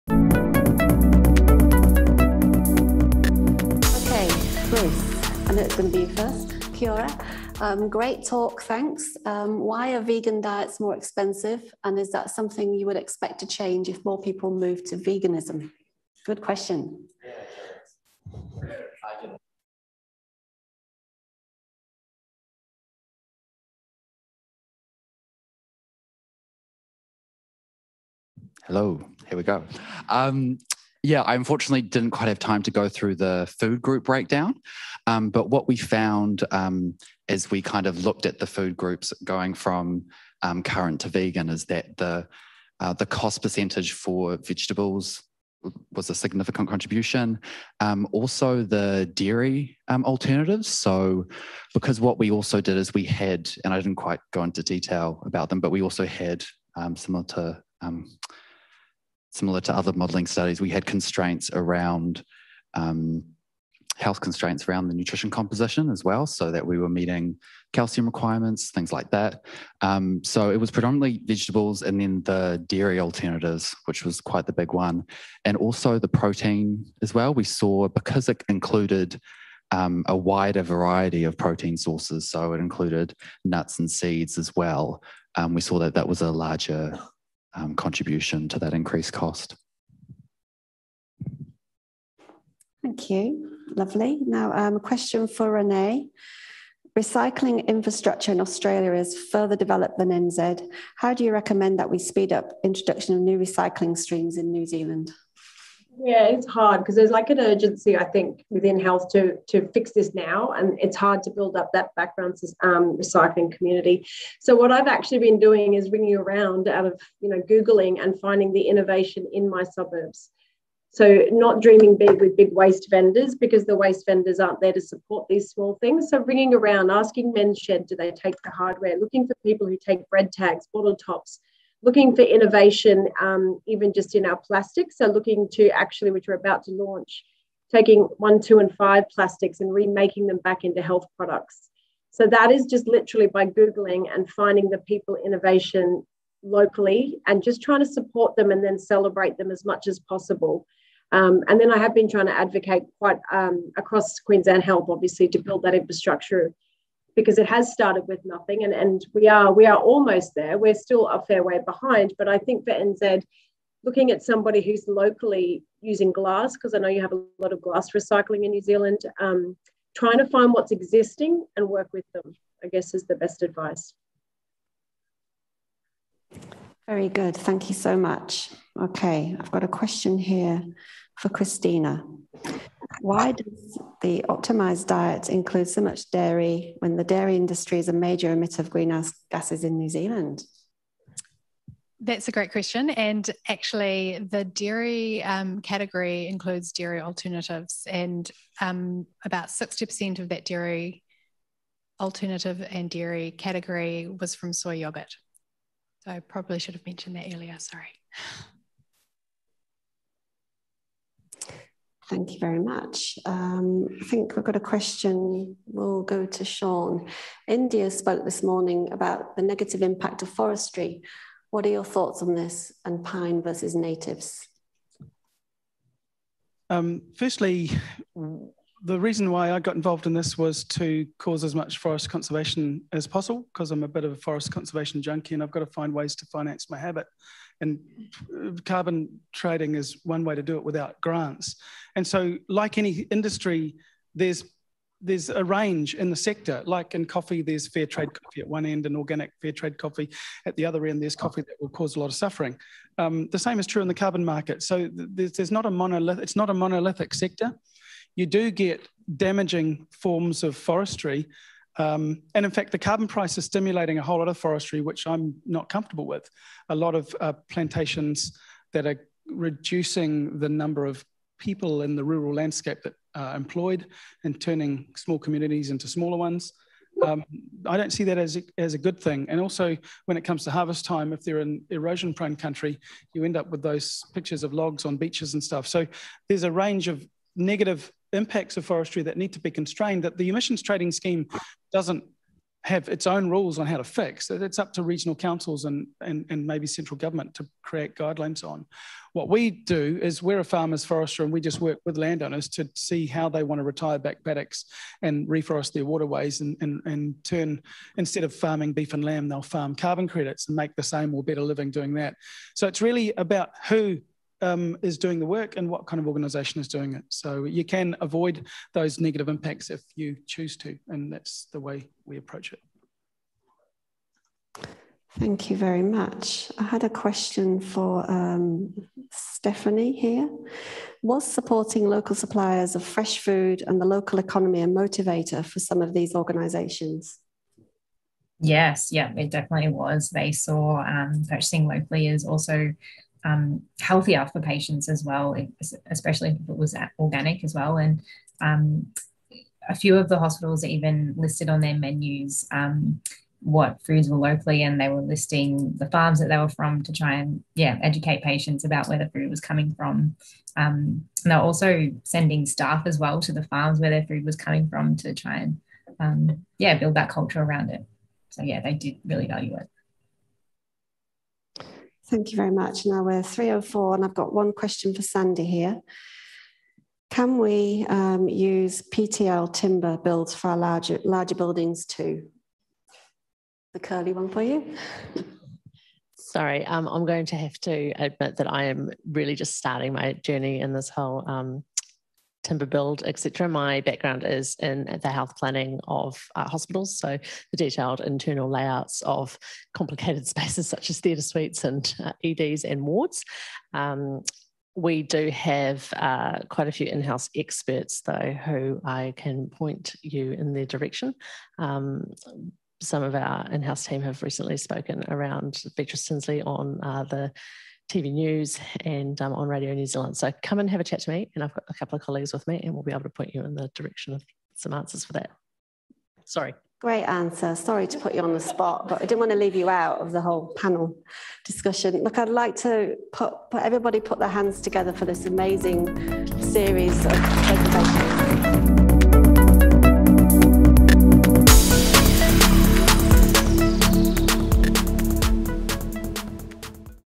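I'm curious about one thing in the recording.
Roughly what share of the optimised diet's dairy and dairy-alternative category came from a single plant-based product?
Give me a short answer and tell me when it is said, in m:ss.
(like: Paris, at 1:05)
60%, at 3:19.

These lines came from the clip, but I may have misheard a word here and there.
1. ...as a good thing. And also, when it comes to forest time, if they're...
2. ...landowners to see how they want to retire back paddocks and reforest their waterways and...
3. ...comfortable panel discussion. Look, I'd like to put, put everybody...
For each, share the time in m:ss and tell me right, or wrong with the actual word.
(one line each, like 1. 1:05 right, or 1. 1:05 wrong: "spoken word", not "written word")
1. 4:38 wrong: "harvest", not "forest"
2. 5:01 right
3. 7:10 wrong: "whole", not "comfortable".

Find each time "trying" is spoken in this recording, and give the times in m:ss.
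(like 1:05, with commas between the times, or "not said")
2:27, 2:32, 2:49.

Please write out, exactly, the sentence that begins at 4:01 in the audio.
And so, like any industry, there's there's a range in the sector.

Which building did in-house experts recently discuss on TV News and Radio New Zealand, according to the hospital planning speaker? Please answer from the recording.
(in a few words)
Beatrice Tinsley.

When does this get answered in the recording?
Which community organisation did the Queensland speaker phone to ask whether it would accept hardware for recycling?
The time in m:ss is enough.
2:07.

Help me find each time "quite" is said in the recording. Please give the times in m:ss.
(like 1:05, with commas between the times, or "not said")
0:32, 0:53, 1:14, 2:32, 6:46.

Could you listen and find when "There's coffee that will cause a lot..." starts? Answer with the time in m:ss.
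4:11.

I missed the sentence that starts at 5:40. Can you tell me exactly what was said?
They saw um, purchasing locally is also um, healthier for patients as well, especially if it was organic as well.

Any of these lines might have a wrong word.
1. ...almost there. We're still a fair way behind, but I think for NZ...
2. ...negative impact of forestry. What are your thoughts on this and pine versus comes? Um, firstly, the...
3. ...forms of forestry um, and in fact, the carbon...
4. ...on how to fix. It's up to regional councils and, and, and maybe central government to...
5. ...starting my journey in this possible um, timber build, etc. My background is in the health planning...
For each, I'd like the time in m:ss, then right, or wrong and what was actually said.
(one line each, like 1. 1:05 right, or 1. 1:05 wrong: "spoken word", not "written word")
1. 2:39 right
2. 3:39 wrong: "natives", not "comes"
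3. 4:19 right
4. 4:53 right
5. 6:29 wrong: "whole", not "possible".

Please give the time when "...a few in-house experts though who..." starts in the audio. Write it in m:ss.
6:46.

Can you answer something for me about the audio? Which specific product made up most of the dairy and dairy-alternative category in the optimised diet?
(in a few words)
Soy yogurt.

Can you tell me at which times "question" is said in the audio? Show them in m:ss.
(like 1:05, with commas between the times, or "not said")
0:16, 1:34, 2:59, 3:12, 3:34, 5:26, 6:14.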